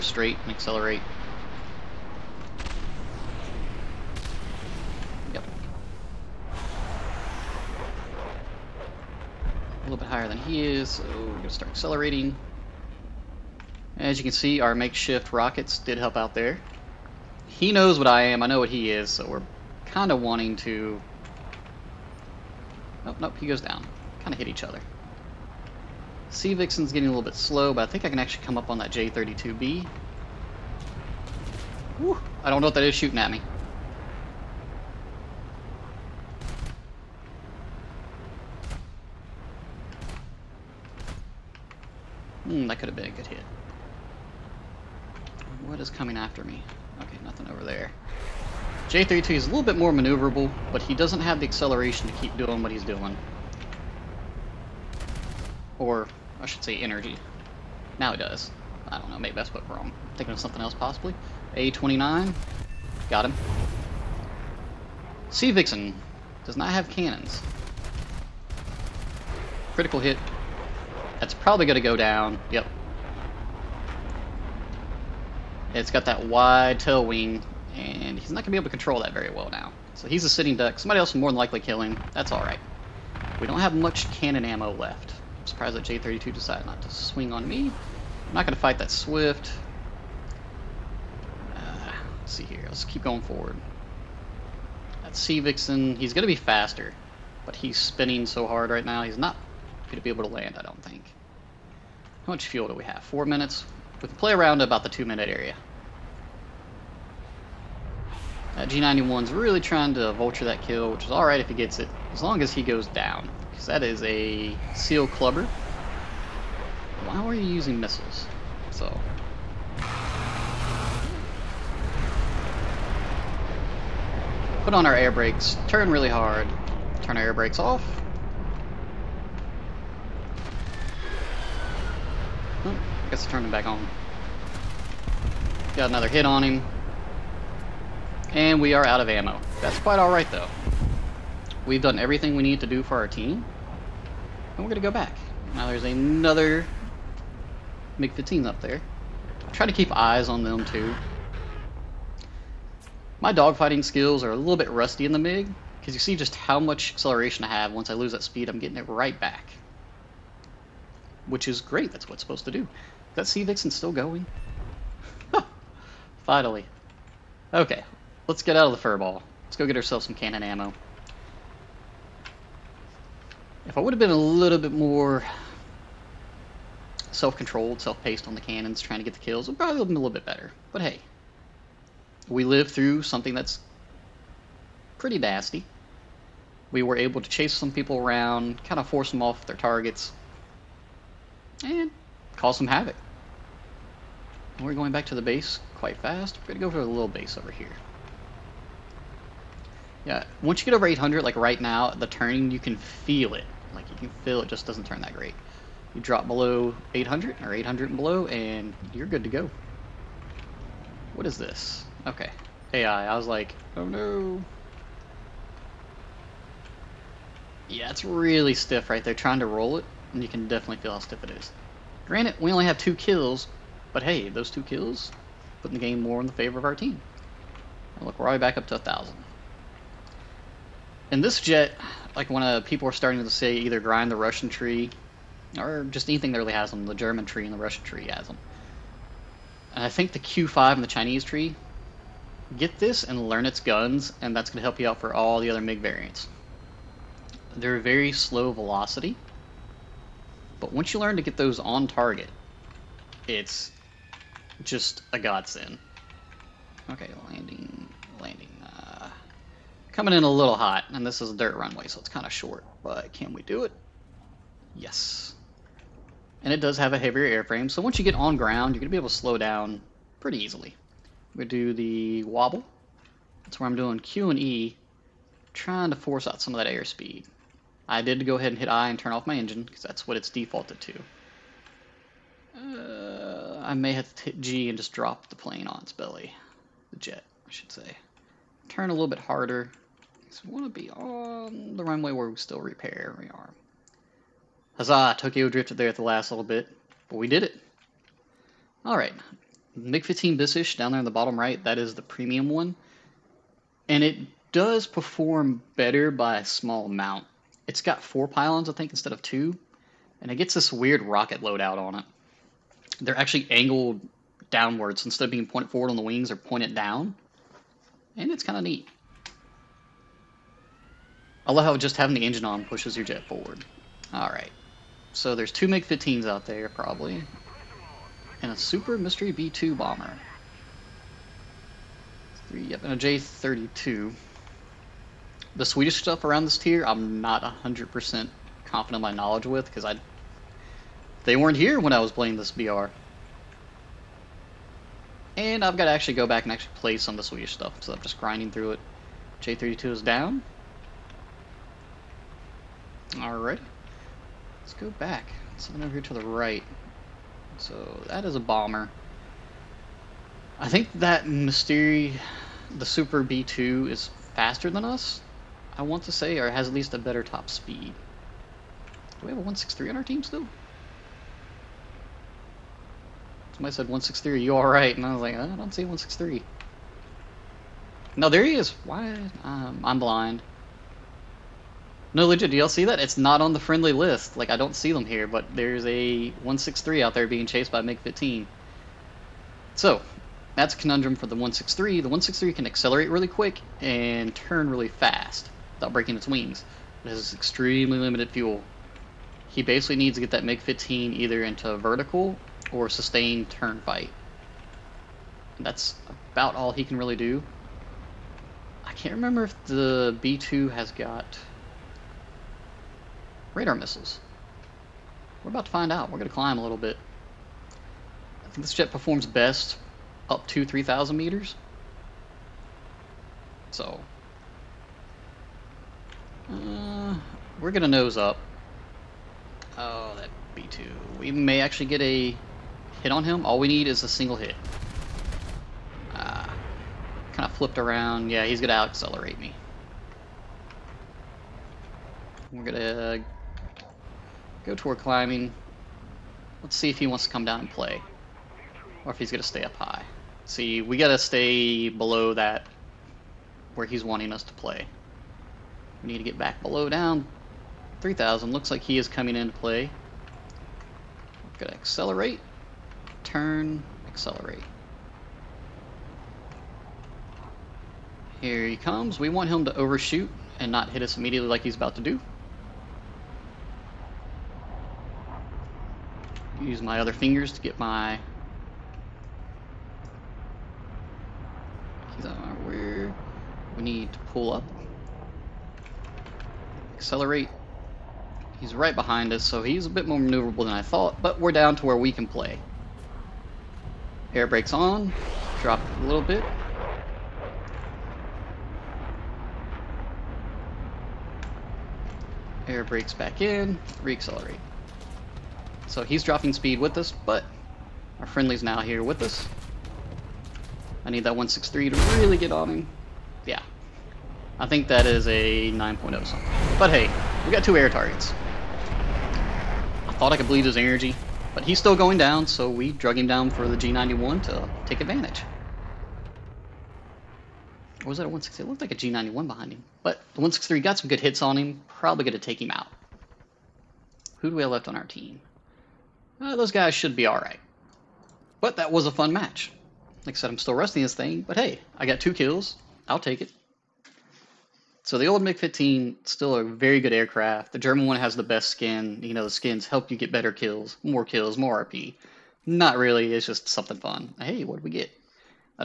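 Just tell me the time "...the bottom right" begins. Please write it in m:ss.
5:01.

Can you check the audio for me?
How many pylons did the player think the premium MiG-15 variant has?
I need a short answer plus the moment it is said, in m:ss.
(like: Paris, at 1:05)
4, at 5:08.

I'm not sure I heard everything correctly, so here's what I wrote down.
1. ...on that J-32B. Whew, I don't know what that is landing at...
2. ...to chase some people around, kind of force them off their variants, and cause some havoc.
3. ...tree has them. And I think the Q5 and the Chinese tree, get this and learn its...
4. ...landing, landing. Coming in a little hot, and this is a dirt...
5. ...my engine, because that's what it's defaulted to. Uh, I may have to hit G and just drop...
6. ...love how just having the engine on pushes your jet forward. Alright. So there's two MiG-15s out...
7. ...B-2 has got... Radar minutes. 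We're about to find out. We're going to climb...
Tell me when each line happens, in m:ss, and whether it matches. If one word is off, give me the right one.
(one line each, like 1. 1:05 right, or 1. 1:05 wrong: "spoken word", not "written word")
1. 0:28 wrong: "shooting", not "landing"
2. 3:07 wrong: "targets", not "variants"
3. 3:57 right
4. 4:17 right
5. 4:39 right
6. 5:21 right
7. 6:50 wrong: "missiles", not "minutes".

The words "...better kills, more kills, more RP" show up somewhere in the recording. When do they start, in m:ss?
9:10.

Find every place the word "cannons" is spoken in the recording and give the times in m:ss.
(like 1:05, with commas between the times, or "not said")
1:06, 1:24, 2:50, 2:58.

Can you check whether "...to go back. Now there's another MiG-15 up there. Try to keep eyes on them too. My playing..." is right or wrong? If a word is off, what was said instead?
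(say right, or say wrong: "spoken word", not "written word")
wrong: "dogfighting", not "playing".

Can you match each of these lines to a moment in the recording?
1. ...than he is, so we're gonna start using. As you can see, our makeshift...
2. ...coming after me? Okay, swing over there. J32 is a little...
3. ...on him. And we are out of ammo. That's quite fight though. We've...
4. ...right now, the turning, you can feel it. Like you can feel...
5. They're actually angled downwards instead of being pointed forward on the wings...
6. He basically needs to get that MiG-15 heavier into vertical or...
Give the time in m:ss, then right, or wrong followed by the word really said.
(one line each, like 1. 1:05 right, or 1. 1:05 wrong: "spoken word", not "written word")
1. 0:10 wrong: "accelerating", not "using"
2. 0:45 wrong: "nothing", not "swing"
3. 2:16 wrong: "alright", not "fight"
4. 3:21 right
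5. 5:13 right
6. 6:39 wrong: "either", not "heavier".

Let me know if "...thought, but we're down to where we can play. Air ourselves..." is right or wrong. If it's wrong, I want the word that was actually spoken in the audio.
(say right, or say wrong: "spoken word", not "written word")
wrong: "brakes", not "ourselves".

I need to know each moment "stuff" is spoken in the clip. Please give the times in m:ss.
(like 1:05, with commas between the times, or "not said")
5:35, 5:47.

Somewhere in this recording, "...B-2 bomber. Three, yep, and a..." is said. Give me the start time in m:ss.
5:29.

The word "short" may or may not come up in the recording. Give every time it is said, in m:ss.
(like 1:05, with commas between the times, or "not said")
4:22.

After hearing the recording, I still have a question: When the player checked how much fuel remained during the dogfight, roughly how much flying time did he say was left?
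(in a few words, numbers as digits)
4 minutes.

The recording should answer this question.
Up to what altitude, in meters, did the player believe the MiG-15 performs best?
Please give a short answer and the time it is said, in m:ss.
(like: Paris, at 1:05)
3,000 meters, at 7:00.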